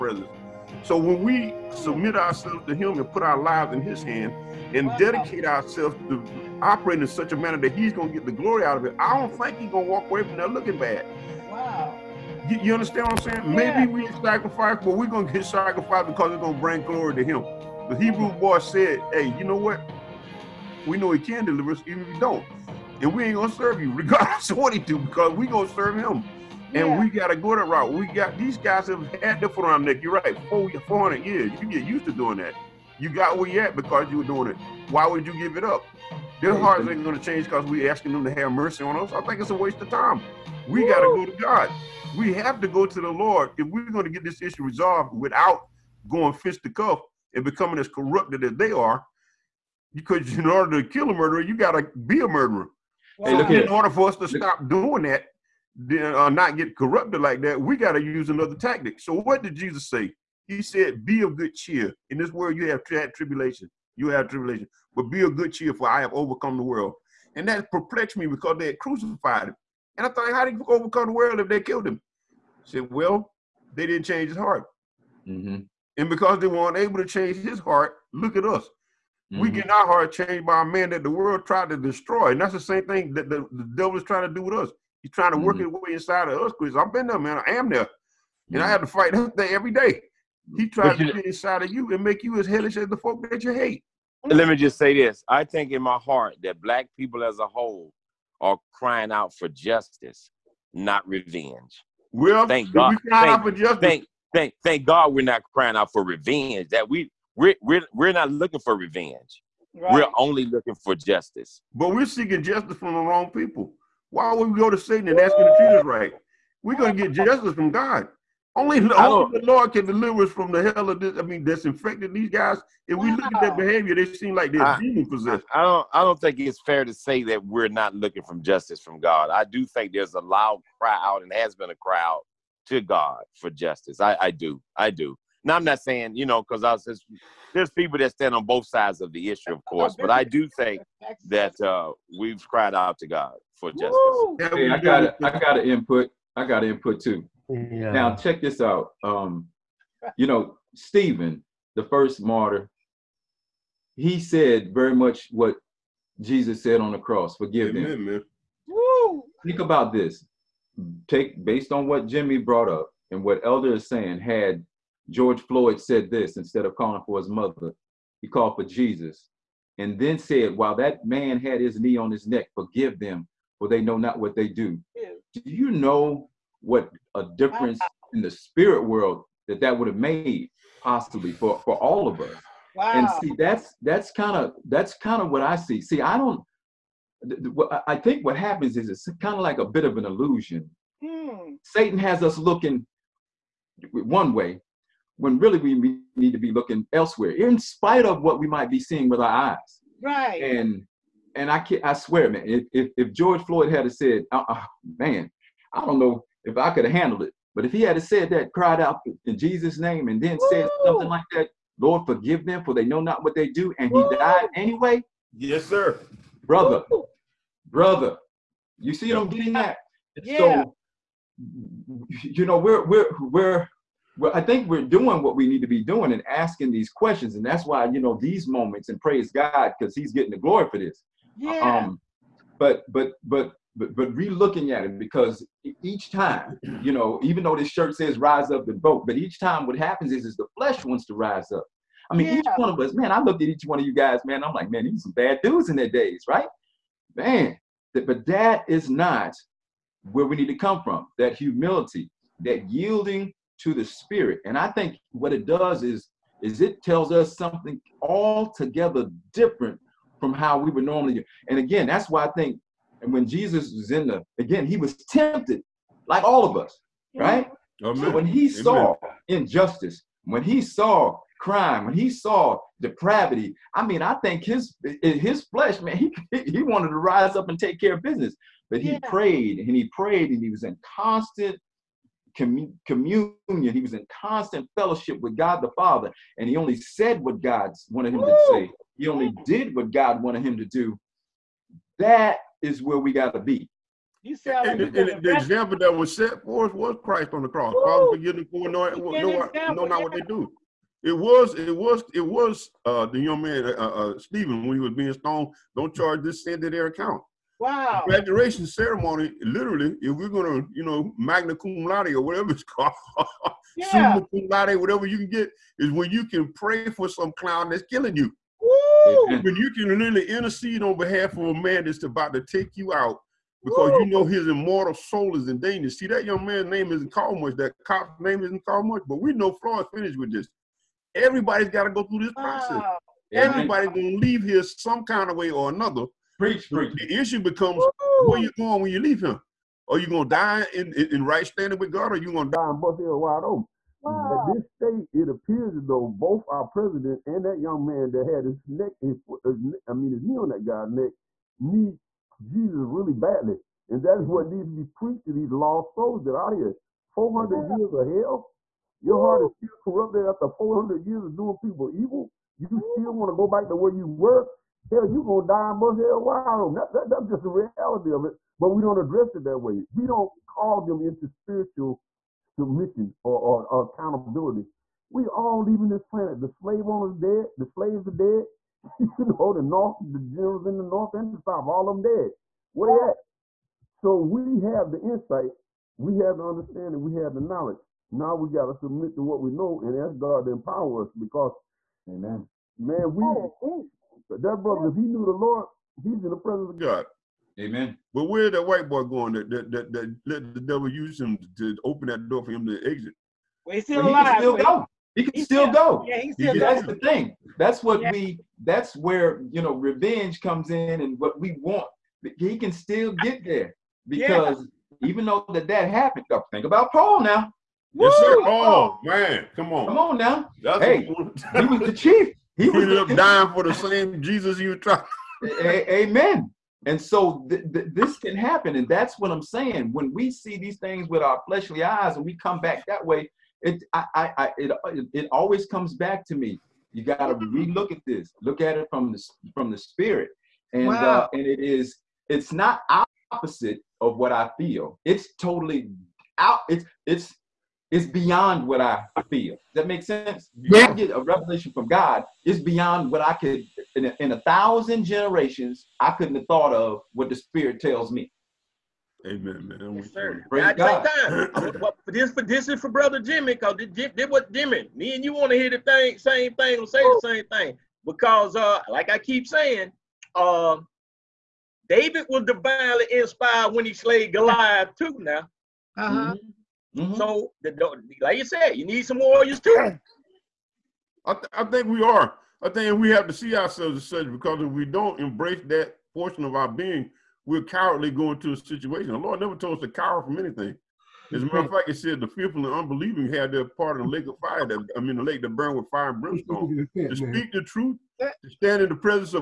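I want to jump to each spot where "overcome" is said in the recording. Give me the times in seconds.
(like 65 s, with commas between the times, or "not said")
66 s, 70 s.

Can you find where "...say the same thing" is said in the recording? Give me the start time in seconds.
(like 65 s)
466 s.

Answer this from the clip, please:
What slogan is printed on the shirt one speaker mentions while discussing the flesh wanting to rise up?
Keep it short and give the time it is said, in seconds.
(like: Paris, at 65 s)
rise up and vote, at 238 s.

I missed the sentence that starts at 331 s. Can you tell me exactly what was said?
Everybody's got to go through this process.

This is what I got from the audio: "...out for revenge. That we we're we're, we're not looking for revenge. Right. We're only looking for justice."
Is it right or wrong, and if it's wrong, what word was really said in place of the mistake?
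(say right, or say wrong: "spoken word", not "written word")
right.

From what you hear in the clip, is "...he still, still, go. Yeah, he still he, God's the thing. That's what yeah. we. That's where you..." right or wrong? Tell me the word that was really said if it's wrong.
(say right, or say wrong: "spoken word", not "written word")
wrong: "That", not "God".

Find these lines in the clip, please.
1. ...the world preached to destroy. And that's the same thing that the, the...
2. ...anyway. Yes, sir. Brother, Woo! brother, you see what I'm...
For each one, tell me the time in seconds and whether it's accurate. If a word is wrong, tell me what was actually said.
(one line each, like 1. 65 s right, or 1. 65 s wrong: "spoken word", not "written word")
1. 81 s wrong: "tried", not "preached"
2. 214 s right.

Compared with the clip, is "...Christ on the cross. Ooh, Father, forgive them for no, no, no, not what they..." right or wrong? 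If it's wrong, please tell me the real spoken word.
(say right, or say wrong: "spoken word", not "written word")
right.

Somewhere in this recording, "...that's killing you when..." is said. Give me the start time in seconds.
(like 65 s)
317 s.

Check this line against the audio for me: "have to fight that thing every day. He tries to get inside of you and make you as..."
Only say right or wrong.
right.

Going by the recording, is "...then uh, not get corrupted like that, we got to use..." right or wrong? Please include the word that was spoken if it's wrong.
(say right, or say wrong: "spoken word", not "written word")
right.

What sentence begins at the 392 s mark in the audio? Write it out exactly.
Man, we that, brother, if he knew the Lord, he's in the presence of God.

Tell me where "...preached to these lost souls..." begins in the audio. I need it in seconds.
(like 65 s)
354 s.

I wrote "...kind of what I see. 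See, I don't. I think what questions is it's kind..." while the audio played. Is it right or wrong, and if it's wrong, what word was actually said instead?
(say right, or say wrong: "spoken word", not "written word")
wrong: "happens", not "questions".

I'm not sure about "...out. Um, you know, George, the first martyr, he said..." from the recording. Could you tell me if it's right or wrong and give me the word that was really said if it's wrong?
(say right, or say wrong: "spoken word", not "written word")
wrong: "Stephen", not "George".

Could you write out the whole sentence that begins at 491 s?
As a matter of fact, it said the fearful and unbelieving had their part in the lake of fire.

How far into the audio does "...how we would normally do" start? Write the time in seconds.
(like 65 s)
260 s.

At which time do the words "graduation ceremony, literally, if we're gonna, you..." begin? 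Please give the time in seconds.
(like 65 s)
308 s.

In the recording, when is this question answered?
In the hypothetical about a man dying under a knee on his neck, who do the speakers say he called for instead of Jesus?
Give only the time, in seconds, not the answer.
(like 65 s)
167 s.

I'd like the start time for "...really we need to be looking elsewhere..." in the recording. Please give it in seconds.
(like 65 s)
195 s.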